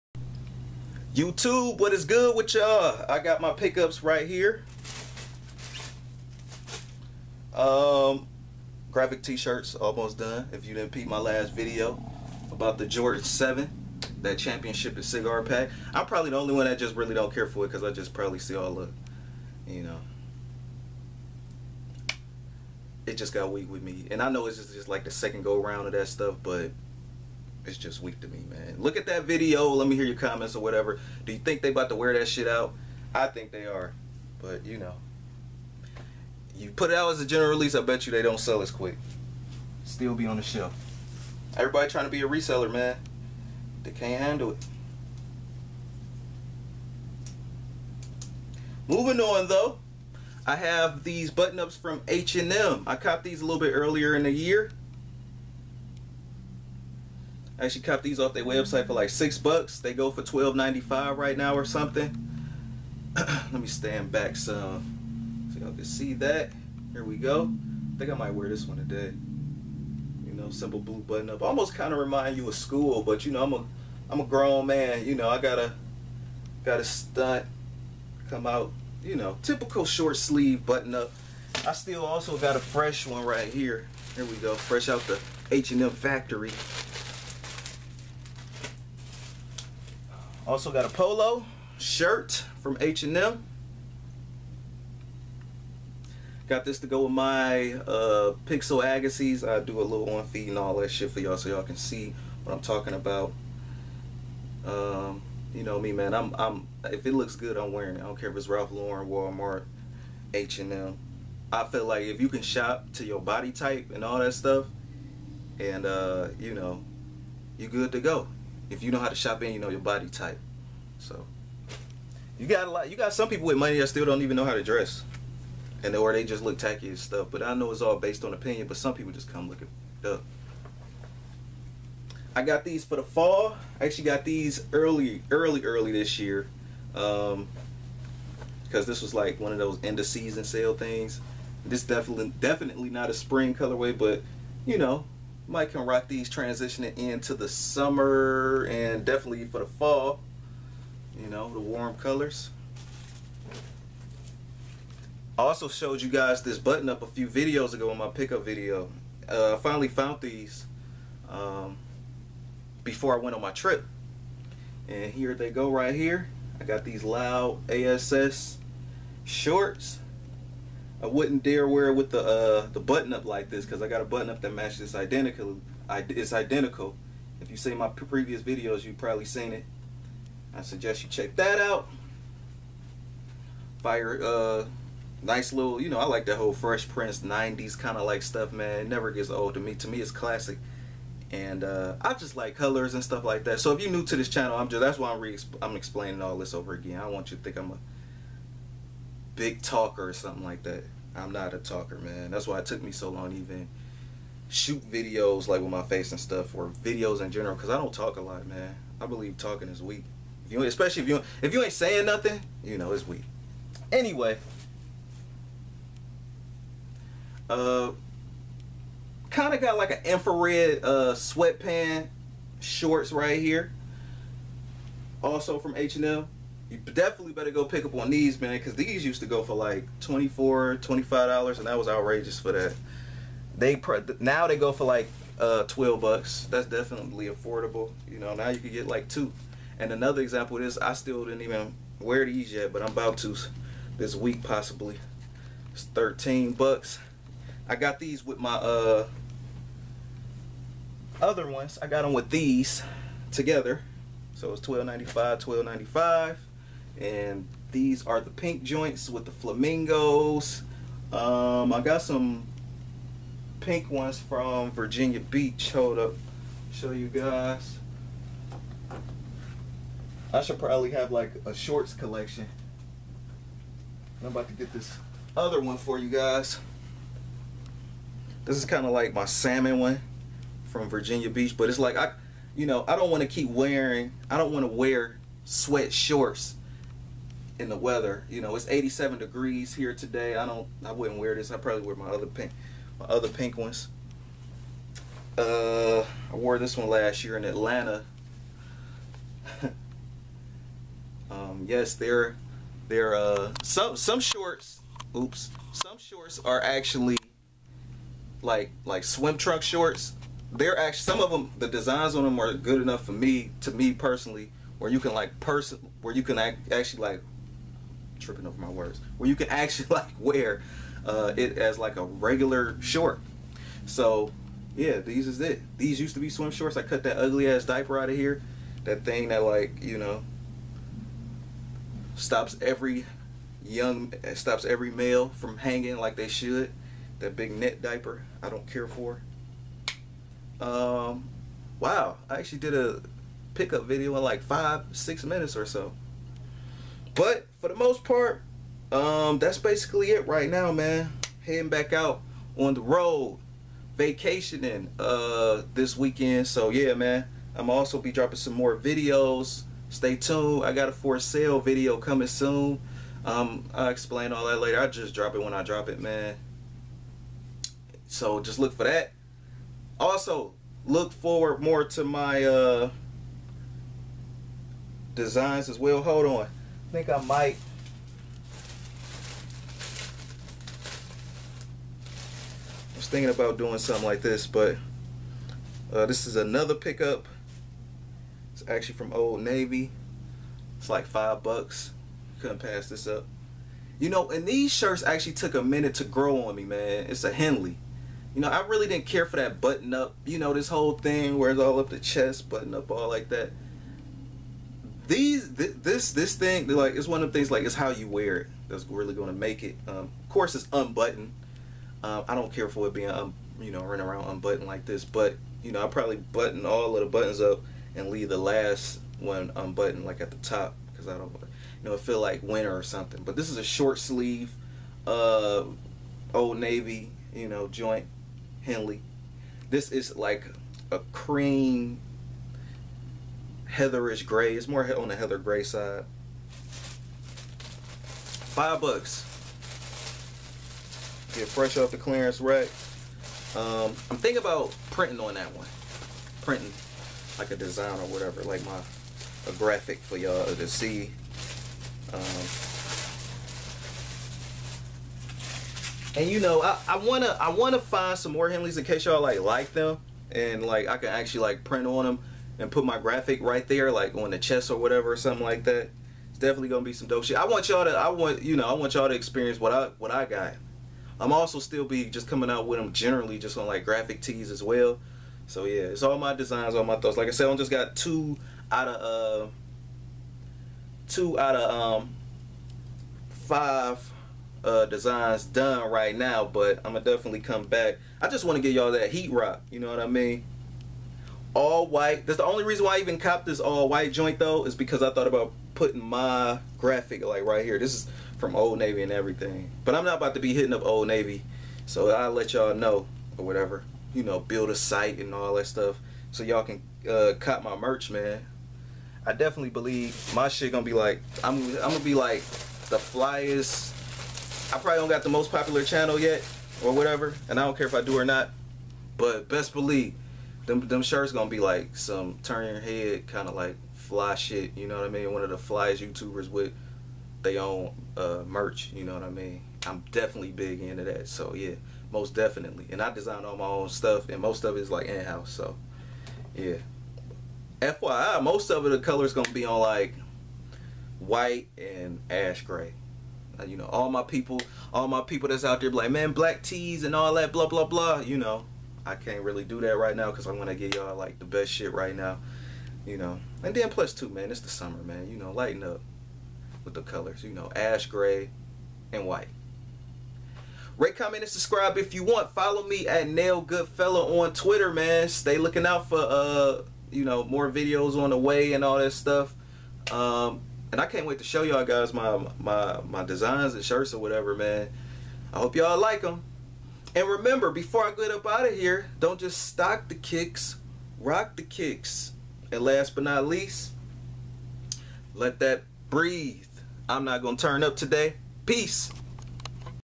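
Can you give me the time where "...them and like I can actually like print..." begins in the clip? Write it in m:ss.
7:39.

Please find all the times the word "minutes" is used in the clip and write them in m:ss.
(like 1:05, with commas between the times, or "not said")
5:45, 6:35.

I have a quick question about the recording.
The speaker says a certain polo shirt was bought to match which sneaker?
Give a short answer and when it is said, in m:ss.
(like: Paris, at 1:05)
Pixel Agassiz, at 1:38.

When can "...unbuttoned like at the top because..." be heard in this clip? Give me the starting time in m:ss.
6:59.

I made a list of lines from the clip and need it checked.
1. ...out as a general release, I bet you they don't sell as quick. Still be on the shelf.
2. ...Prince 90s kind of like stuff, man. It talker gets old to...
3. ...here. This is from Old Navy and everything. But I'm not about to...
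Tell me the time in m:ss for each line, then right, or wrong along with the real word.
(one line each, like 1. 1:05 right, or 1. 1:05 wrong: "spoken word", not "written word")
1. 0:36 right
2. 3:06 wrong: "never", not "talker"
3. 8:17 right.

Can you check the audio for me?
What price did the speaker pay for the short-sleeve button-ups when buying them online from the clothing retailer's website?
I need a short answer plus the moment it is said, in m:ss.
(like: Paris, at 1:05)
$6, at 0:59.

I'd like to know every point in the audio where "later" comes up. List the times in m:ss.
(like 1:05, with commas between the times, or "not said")
6:04.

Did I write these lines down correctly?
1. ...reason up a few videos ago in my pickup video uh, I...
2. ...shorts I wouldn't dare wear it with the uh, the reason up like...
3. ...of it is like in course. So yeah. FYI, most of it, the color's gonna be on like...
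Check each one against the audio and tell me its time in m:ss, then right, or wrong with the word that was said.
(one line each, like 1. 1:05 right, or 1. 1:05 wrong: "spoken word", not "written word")
1. 2:36 wrong: "button", not "reason"
2. 2:49 wrong: "button", not "reason"
3. 8:54 wrong: "house", not "course".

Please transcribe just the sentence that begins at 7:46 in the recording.
It's definitely gonna be some dope shit.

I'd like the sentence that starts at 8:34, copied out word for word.
I probably don't got the most popular channel yet or whatever, and I don't care if I do or not.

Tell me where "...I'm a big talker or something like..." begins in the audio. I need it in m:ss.
3:17.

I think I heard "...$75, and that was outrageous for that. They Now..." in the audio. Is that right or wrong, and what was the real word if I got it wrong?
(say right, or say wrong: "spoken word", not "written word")
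wrong: "25", not "75".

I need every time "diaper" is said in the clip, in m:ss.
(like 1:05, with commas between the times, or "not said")
5:27, 5:37.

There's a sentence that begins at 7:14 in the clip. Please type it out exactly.
It's more on the heather gray side.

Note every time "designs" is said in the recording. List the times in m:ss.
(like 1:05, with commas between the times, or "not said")
5:11, 6:15, 7:27, 7:56, 8:04, 8:53, 9:33.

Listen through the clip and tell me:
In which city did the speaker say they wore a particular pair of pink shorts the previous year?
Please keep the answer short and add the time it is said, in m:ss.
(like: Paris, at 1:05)
Atlanta, at 4:57.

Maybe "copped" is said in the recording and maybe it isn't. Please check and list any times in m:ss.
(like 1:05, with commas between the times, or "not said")
0:52, 8:13.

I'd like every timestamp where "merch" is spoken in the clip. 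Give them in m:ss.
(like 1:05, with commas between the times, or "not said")
8:27, 8:48.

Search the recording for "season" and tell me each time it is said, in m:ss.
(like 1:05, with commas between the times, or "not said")
2:20.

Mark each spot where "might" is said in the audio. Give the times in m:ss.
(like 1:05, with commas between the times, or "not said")
1:08, 2:25, 6:17.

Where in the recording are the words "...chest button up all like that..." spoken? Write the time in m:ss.
6:41.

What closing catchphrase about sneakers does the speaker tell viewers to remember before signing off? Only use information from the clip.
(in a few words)
Don't just stock the kicks, rock the kicks.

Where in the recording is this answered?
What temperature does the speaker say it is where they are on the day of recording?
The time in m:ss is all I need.
4:48.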